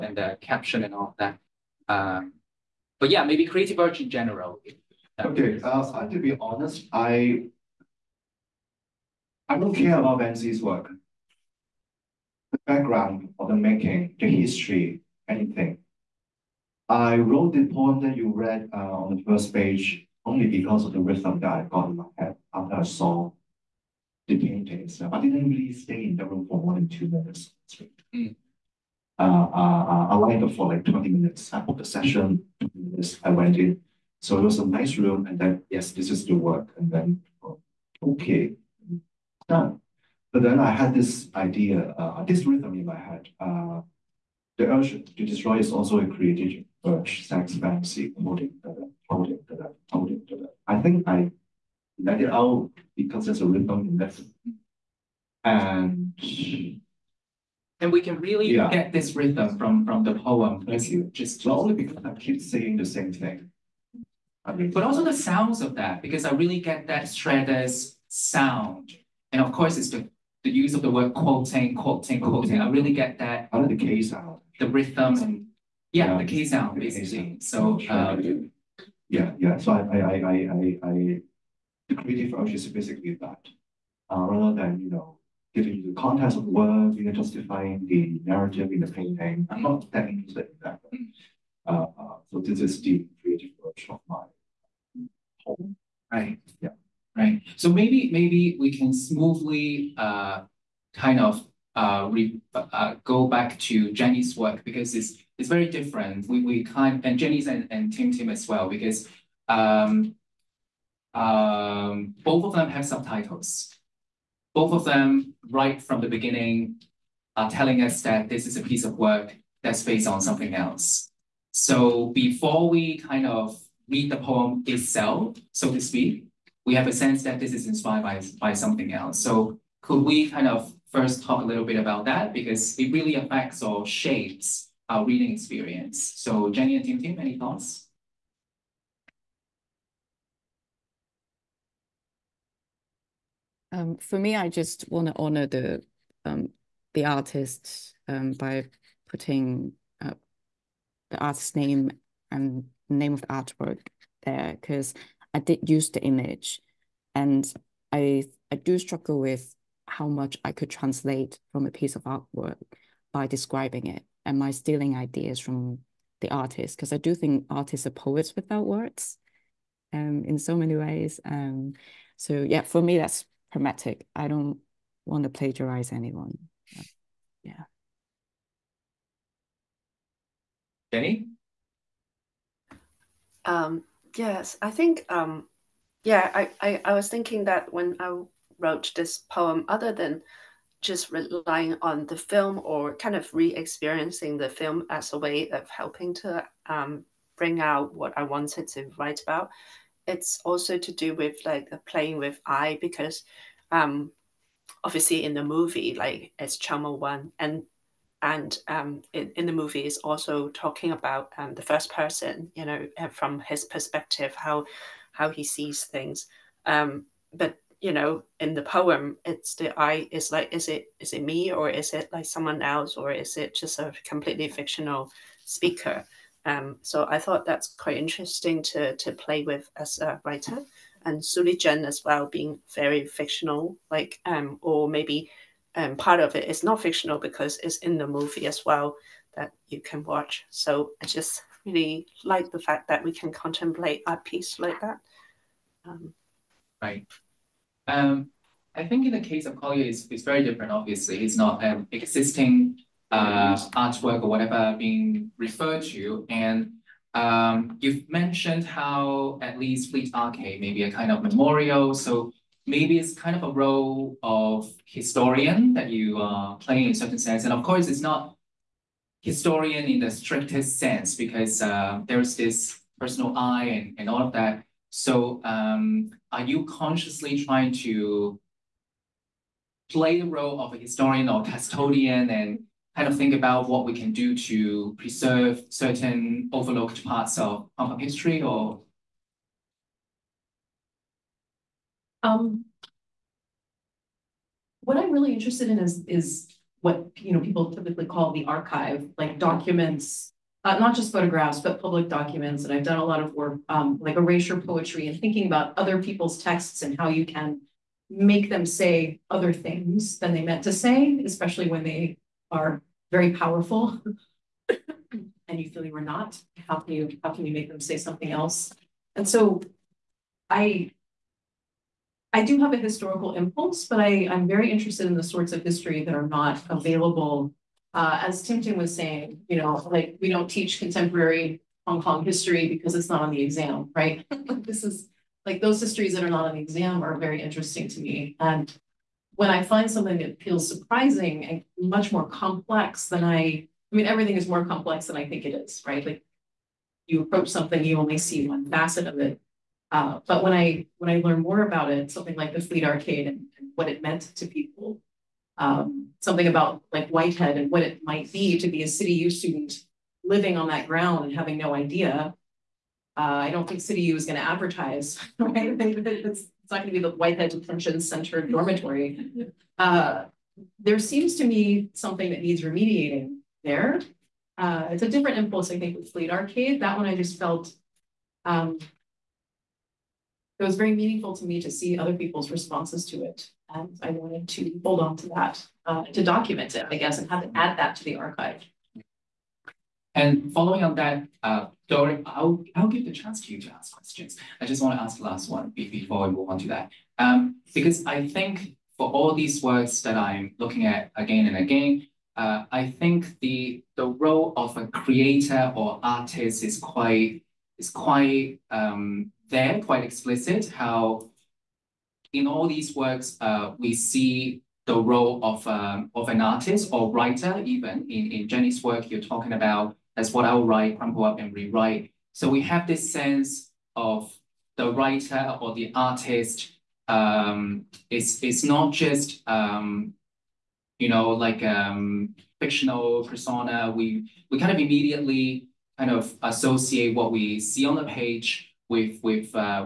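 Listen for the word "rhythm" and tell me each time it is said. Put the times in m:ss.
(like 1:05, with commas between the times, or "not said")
0:21, 0:42, 0:53, 0:59, 1:14.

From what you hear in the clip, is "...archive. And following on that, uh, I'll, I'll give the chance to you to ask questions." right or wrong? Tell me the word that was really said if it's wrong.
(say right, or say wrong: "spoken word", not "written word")
right.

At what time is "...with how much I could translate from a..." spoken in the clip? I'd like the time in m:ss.
2:39.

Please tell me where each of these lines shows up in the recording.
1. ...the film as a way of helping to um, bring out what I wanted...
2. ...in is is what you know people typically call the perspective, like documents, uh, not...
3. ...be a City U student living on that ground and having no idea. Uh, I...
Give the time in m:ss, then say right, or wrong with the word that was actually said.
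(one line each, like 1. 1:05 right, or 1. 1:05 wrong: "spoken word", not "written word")
1. 3:14 right
2. 4:55 wrong: "archive", not "perspective"
3. 5:58 right.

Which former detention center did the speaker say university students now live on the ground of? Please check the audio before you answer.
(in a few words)
Whitehead Detention Center.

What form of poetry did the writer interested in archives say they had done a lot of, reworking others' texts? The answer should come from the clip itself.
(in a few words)
erasure poetry.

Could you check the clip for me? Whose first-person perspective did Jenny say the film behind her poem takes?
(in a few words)
Chow Mo-wan.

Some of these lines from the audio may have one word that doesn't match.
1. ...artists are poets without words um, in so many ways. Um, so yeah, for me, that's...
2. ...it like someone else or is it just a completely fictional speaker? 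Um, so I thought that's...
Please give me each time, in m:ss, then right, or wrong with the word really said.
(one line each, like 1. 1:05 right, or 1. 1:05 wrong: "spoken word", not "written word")
1. 2:47 right
2. 3:41 right.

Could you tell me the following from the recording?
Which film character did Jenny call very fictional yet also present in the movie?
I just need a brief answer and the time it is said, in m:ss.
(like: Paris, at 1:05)
Su Li-zhen, at 3:51.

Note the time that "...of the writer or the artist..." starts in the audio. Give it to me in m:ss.
7:03.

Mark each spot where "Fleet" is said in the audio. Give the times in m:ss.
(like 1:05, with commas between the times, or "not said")
4:19, 5:52, 6:16.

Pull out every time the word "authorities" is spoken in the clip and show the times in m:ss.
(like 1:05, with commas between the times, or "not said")
not said.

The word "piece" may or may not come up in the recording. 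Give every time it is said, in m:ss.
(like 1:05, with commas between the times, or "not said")
1:58, 2:41, 4:04.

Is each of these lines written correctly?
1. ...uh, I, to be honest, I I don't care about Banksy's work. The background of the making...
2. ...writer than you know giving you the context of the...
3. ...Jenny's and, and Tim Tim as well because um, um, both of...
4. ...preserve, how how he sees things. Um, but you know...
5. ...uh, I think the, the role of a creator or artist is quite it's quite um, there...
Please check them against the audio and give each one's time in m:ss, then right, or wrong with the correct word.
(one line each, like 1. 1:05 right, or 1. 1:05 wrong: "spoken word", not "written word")
1. 0:05 right
2. 1:24 wrong: "rather", not "writer"
3. 1:47 right
4. 3:33 wrong: "perspective", not "preserve"
5. 6:42 right.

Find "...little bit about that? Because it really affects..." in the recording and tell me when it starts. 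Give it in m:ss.
2:11.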